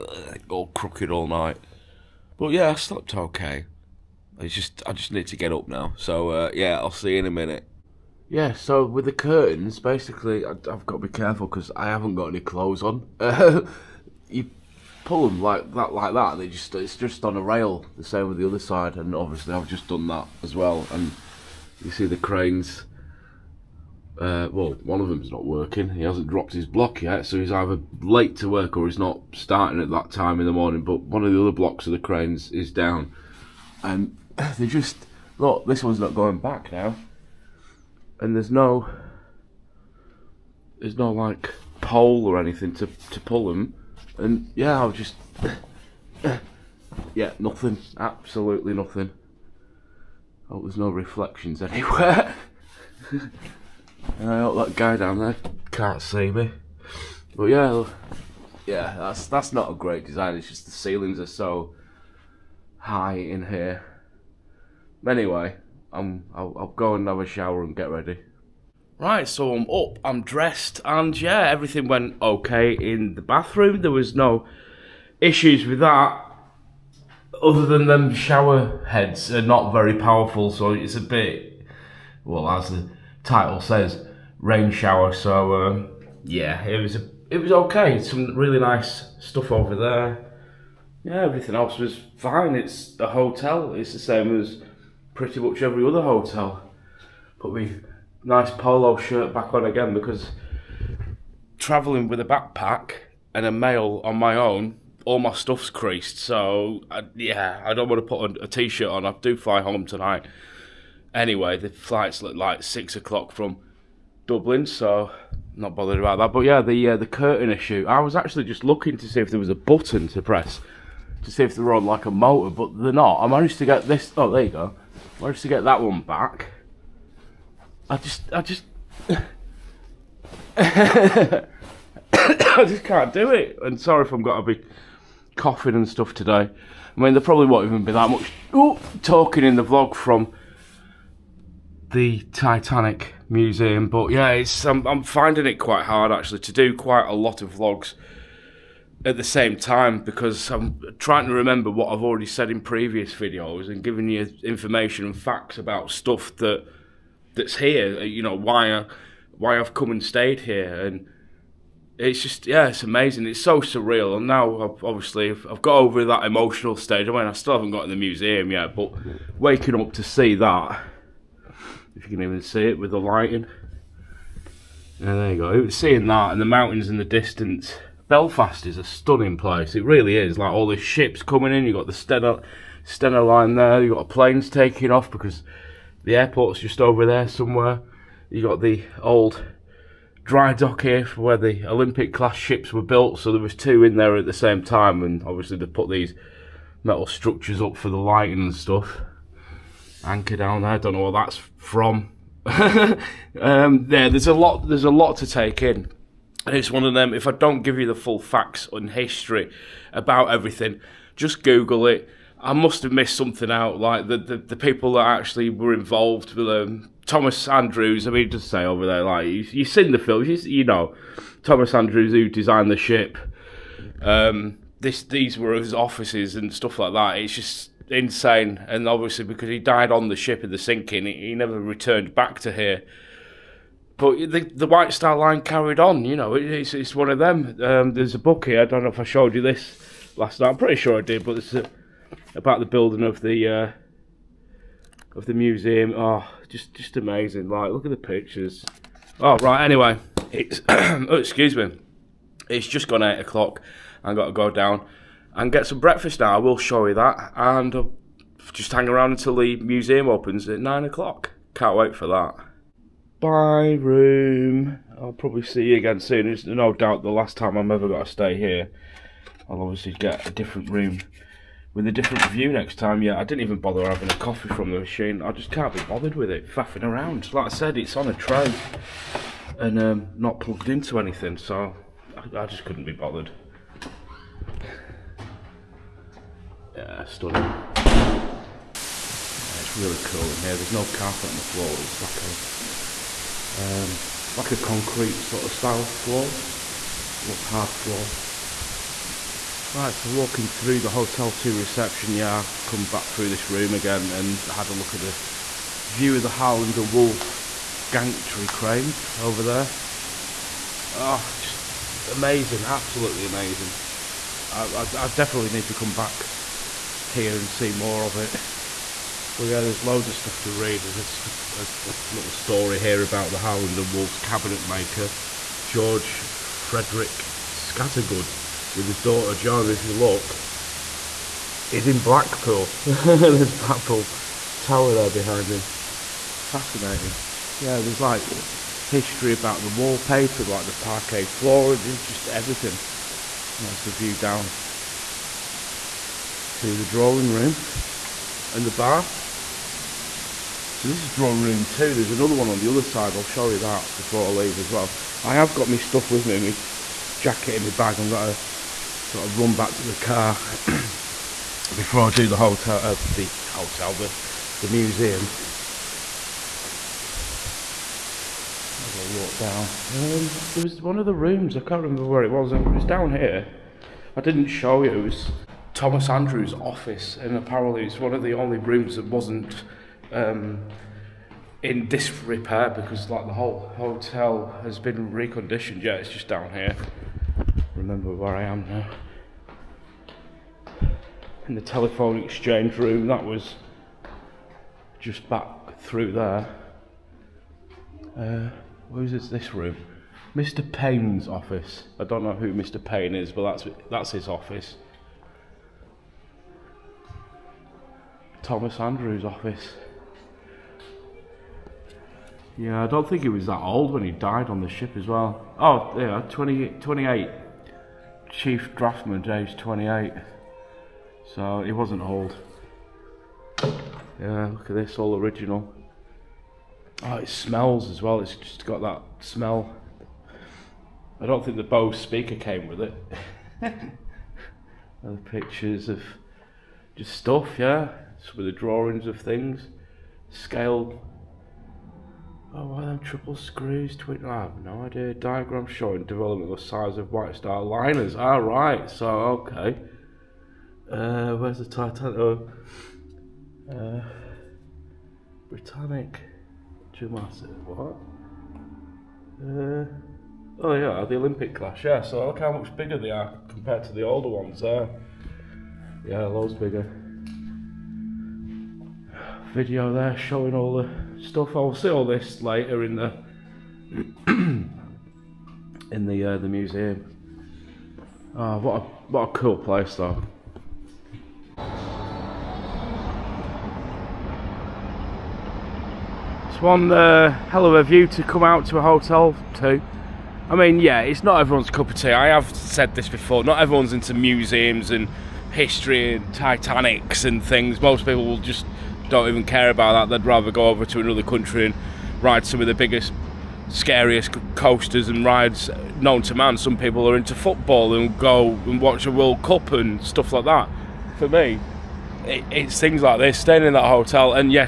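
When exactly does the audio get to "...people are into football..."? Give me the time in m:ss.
8:26.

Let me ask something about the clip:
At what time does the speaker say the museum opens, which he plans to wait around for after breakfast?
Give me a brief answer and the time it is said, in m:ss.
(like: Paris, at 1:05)
9 o'clock, at 4:20.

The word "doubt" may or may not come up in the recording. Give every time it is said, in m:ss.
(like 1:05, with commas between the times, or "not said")
4:26.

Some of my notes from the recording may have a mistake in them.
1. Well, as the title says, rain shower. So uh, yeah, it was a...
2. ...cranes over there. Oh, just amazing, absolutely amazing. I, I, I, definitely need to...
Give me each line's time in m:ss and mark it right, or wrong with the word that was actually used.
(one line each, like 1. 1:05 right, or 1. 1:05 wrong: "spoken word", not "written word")
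1. 1:22 right
2. 5:08 right.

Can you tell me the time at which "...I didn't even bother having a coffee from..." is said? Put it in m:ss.
4:33.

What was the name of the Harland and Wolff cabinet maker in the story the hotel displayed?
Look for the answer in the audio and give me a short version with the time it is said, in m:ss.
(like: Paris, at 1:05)
George Frederick Scattergood, at 5:25.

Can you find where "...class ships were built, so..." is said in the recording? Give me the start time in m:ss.
3:12.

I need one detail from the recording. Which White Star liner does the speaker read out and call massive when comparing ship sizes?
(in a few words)
Britannic.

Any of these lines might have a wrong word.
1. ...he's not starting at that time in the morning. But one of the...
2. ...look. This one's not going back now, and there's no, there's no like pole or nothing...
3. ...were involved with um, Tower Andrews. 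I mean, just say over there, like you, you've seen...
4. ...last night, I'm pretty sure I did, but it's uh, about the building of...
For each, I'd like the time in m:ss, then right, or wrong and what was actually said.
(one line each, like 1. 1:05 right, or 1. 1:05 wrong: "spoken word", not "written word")
1. 0:28 right
2. 0:35 wrong: "anything", not "nothing"
3. 3:35 wrong: "Thomas", not "Tower"
4. 4:00 right.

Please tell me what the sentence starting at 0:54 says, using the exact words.
And I hope that guy down there can't see me.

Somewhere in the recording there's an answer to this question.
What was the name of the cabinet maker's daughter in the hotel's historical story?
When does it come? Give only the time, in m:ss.
5:29.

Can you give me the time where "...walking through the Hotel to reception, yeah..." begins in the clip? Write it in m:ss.
5:00.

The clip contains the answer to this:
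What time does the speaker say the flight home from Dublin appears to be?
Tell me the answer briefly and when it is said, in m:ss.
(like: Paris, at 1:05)
6 o'clock, at 1:52.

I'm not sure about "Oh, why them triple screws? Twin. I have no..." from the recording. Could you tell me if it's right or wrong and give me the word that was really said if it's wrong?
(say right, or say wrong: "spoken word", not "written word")
right.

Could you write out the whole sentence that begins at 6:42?
Payne is, but that's that's his office.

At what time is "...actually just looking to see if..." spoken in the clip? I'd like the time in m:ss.
1:58.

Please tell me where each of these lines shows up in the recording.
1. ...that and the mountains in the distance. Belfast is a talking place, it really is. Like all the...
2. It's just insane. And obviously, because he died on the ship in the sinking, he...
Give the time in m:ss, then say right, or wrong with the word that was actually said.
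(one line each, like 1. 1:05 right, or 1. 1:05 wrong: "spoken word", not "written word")
1. 2:56 wrong: "stunning", not "talking"
2. 3:47 right.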